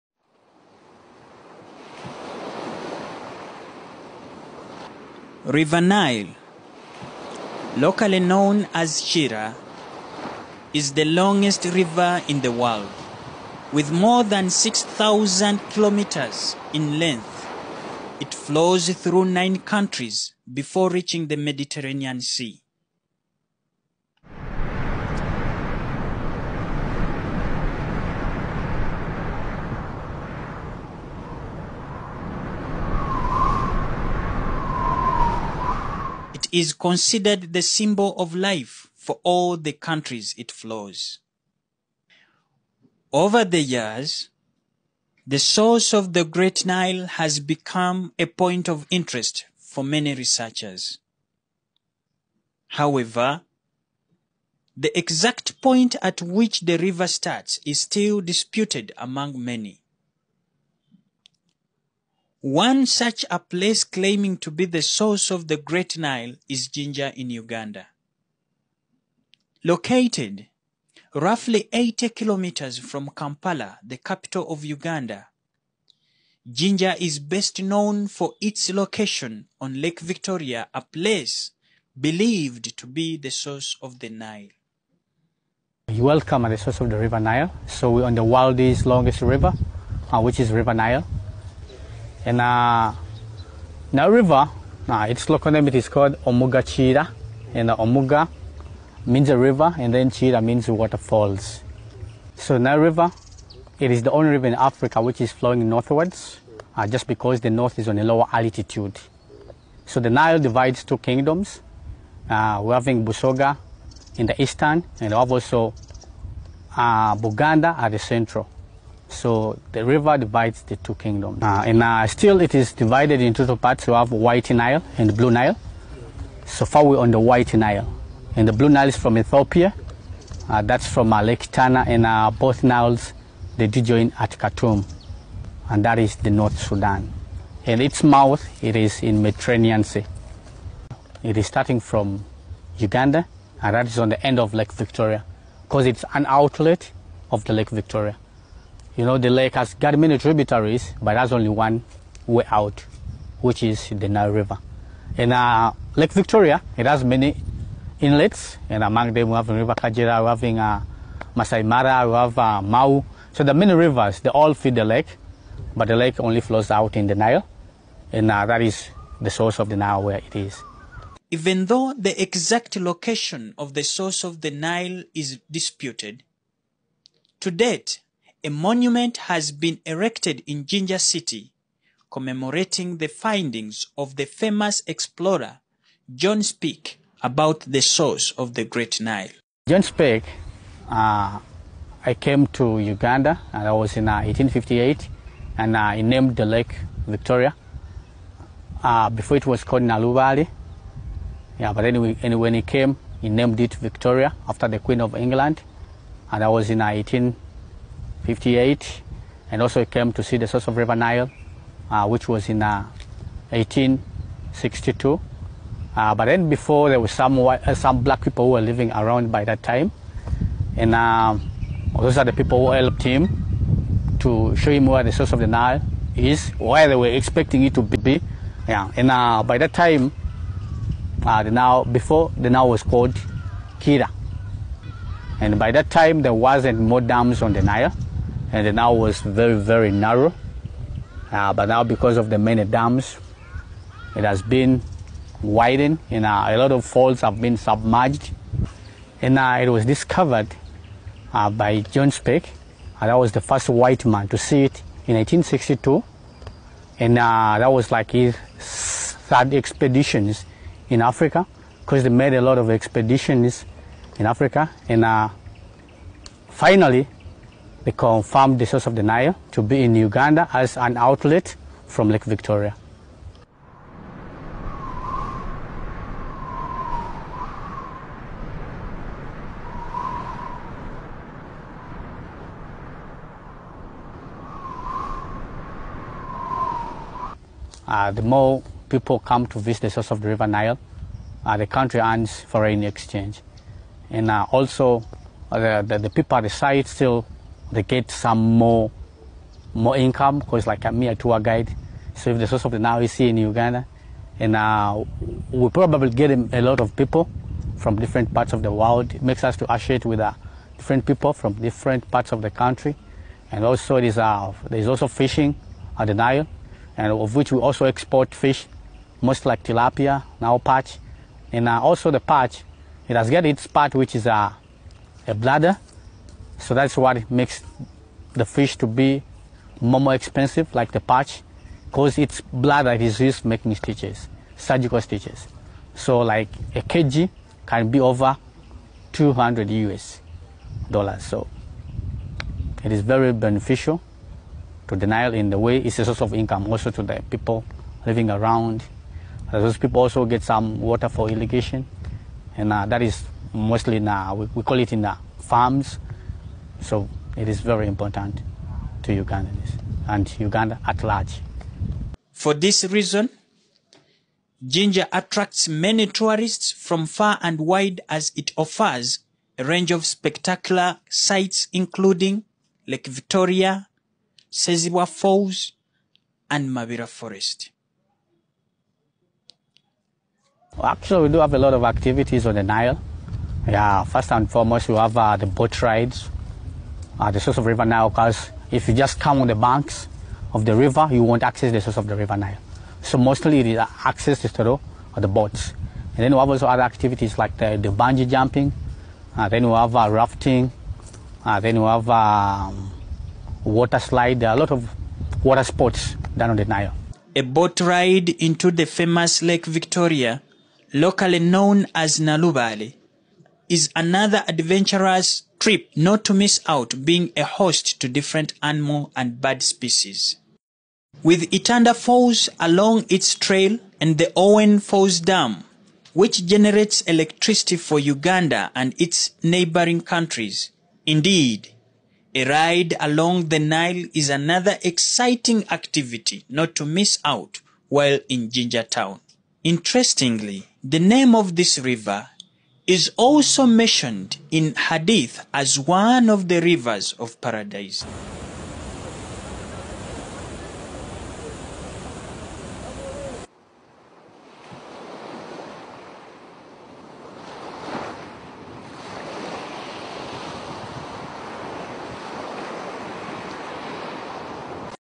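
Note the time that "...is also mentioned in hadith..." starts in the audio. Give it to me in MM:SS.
07:22.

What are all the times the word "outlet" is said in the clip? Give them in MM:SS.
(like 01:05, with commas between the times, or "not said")
02:26, 04:30.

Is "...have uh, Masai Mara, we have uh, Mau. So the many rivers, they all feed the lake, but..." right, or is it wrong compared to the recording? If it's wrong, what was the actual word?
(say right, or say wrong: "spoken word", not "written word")
right.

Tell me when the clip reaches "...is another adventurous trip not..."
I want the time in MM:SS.
06:53.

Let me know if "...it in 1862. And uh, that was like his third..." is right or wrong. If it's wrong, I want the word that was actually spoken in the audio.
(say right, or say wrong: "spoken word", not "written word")
right.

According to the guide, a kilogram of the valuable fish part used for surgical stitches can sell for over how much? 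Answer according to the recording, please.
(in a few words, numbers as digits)
200 US dollars.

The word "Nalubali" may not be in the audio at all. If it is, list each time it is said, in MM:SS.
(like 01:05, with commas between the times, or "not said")
03:19, 06:52.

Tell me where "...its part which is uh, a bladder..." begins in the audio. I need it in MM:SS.
05:23.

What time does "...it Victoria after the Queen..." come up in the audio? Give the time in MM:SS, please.
03:23.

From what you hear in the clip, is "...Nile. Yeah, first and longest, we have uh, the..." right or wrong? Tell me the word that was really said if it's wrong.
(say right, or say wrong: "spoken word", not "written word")
wrong: "foremost", not "longest".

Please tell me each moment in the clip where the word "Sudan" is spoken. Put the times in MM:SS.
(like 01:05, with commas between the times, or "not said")
02:16.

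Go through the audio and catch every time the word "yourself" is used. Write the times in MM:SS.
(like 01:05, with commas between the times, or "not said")
not said.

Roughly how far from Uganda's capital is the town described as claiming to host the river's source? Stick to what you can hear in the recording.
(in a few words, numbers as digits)
80 kilometers.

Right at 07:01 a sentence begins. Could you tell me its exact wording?
With Itanda Falls along its trail and the Owen Falls Dam, which generates electricity for Uganda and its neighboring countries.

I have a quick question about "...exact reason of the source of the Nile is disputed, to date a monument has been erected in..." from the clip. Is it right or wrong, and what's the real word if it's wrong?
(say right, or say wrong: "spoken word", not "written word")
wrong: "location", not "reason".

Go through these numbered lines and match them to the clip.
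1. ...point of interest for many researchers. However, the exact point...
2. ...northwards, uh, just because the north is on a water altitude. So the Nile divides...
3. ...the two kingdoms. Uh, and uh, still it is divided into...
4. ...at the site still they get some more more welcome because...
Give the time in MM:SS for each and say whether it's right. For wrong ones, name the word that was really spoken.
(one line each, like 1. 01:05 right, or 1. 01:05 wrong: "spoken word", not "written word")
1. 00:48 right
2. 01:45 wrong: "lower", not "water"
3. 02:00 right
4. 04:56 wrong: "income", not "welcome".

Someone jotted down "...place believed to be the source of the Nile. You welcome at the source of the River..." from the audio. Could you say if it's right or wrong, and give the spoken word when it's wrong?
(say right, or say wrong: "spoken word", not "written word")
right.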